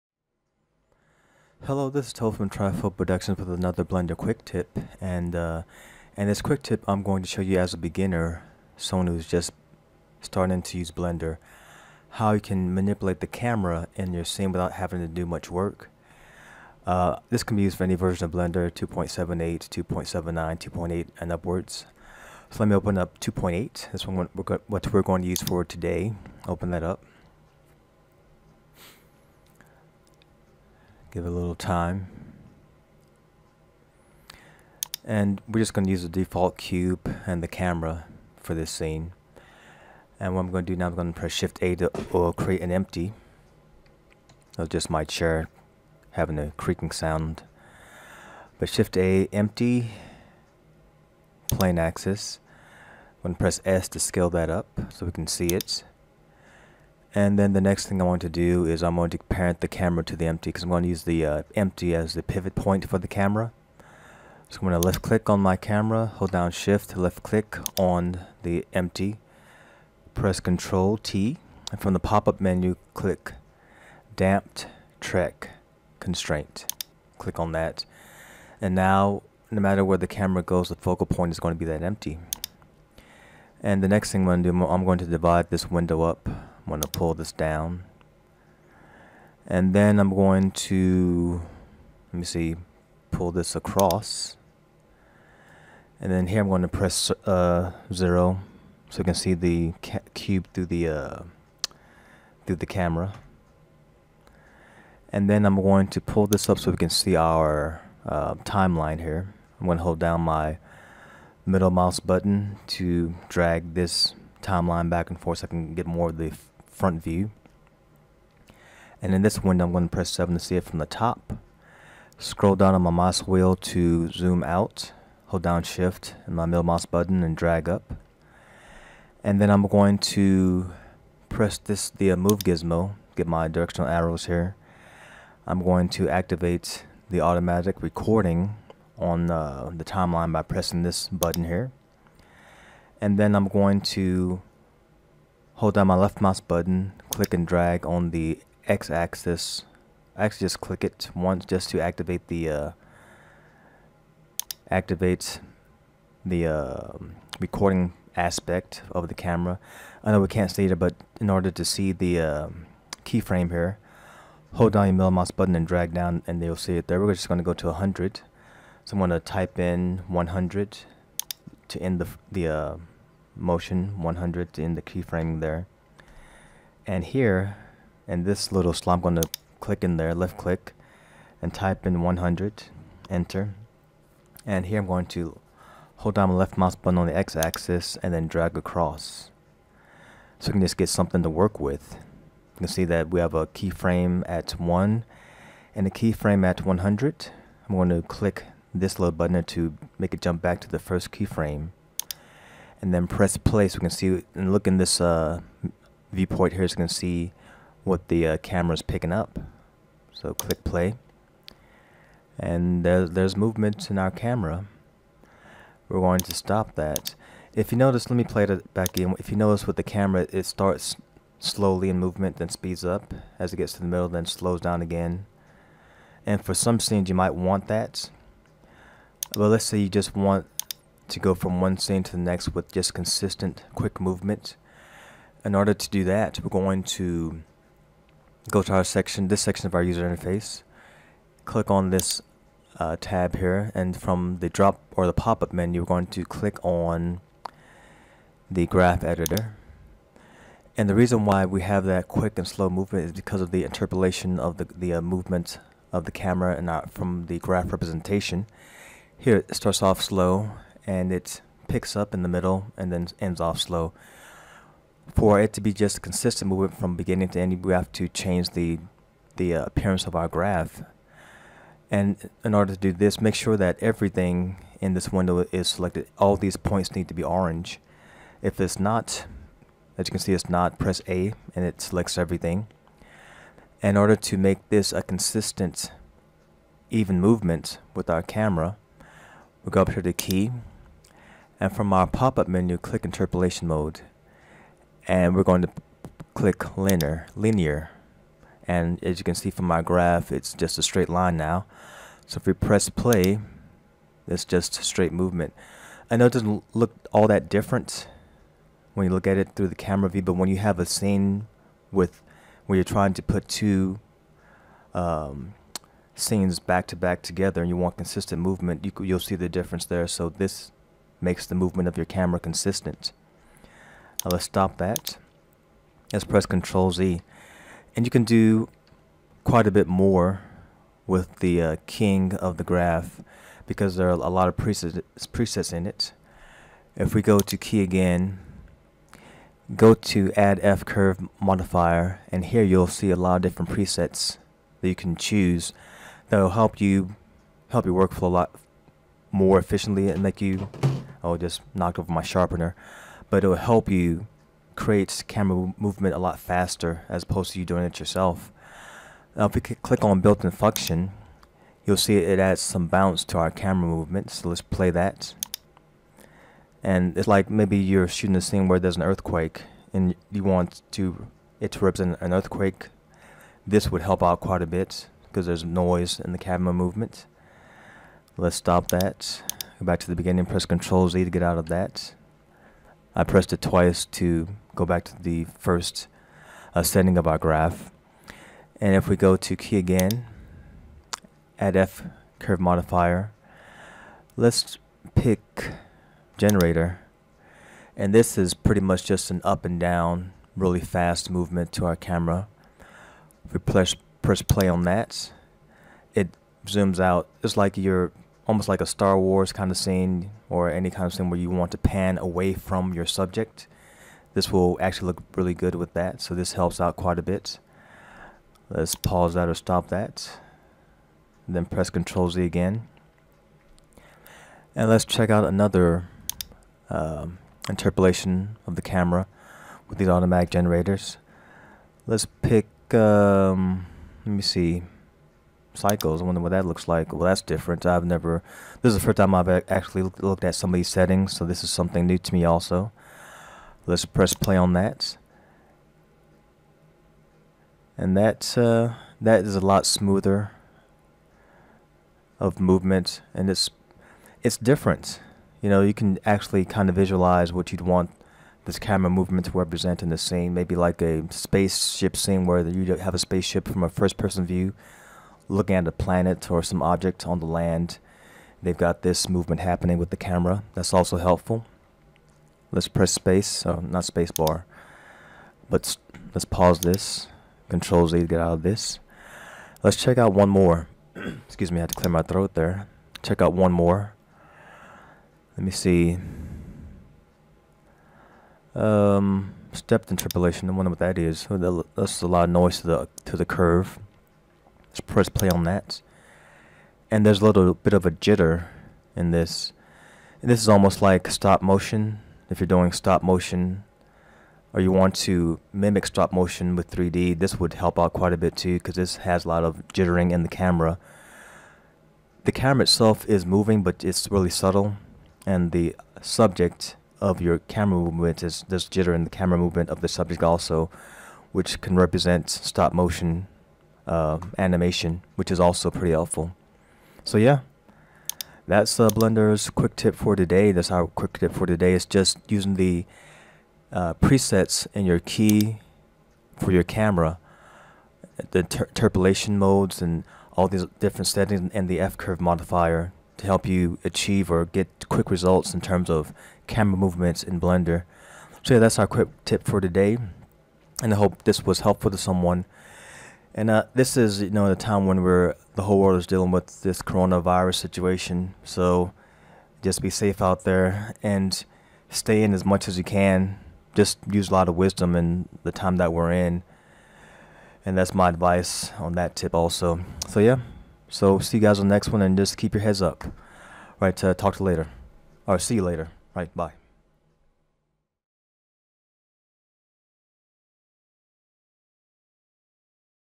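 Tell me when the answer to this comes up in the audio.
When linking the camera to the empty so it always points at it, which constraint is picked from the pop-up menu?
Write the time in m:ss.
1:14.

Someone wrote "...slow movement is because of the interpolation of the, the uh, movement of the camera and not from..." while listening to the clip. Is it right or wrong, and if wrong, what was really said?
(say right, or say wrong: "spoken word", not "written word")
right.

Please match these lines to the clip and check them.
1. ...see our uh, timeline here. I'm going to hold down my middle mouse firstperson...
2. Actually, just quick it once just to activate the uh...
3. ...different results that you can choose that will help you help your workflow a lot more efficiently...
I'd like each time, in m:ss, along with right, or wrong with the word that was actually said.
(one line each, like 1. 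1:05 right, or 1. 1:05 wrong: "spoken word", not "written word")
1. 1:46 wrong: "button", not "firstperson"
2. 2:30 wrong: "click", not "quick"
3. 5:43 wrong: "presets", not "results".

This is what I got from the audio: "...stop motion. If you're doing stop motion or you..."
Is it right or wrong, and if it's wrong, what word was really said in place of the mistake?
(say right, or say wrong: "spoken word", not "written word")
right.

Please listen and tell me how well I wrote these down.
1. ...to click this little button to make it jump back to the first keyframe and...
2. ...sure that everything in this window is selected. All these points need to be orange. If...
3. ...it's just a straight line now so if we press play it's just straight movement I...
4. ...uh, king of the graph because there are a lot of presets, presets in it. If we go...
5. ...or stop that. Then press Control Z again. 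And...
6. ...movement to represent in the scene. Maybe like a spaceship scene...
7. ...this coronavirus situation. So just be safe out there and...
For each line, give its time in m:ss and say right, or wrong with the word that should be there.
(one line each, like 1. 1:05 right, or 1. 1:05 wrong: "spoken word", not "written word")
1. 3:17 right
2. 4:33 right
3. 5:00 right
4. 5:31 right
5. 6:59 right
6. 7:39 right
7. 9:16 right.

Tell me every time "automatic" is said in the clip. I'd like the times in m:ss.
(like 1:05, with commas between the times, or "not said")
2:17, 7:10.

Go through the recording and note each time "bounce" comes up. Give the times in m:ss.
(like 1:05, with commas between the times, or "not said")
6:02.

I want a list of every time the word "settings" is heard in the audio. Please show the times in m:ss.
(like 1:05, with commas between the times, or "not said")
6:26, 7:20, 9:01.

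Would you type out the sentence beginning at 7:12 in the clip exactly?
Let's pick, um, let me see, cycles.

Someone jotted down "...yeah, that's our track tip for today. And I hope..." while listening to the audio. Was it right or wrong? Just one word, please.
wrong.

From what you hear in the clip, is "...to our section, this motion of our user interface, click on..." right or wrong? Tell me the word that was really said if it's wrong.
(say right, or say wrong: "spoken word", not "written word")
wrong: "section", not "motion".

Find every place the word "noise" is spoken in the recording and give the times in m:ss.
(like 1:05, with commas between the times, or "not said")
6:15, 8:12.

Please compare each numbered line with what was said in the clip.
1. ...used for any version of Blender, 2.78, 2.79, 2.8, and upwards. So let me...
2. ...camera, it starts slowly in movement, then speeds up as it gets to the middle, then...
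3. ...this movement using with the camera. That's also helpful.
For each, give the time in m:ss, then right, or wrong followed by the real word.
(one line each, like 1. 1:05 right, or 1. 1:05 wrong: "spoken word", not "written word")
1. 0:17 right
2. 3:39 right
3. 7:49 wrong: "happening", not "using".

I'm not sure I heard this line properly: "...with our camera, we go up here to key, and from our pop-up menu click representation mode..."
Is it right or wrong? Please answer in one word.
wrong.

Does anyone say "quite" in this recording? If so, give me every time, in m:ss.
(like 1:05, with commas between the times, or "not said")
5:29, 6:14, 6:56, 8:28.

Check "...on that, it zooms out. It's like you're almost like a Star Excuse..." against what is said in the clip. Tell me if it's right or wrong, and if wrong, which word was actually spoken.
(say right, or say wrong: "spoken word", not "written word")
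wrong: "Wars", not "Excuse".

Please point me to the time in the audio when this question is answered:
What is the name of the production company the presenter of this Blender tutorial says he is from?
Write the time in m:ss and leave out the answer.
0:02.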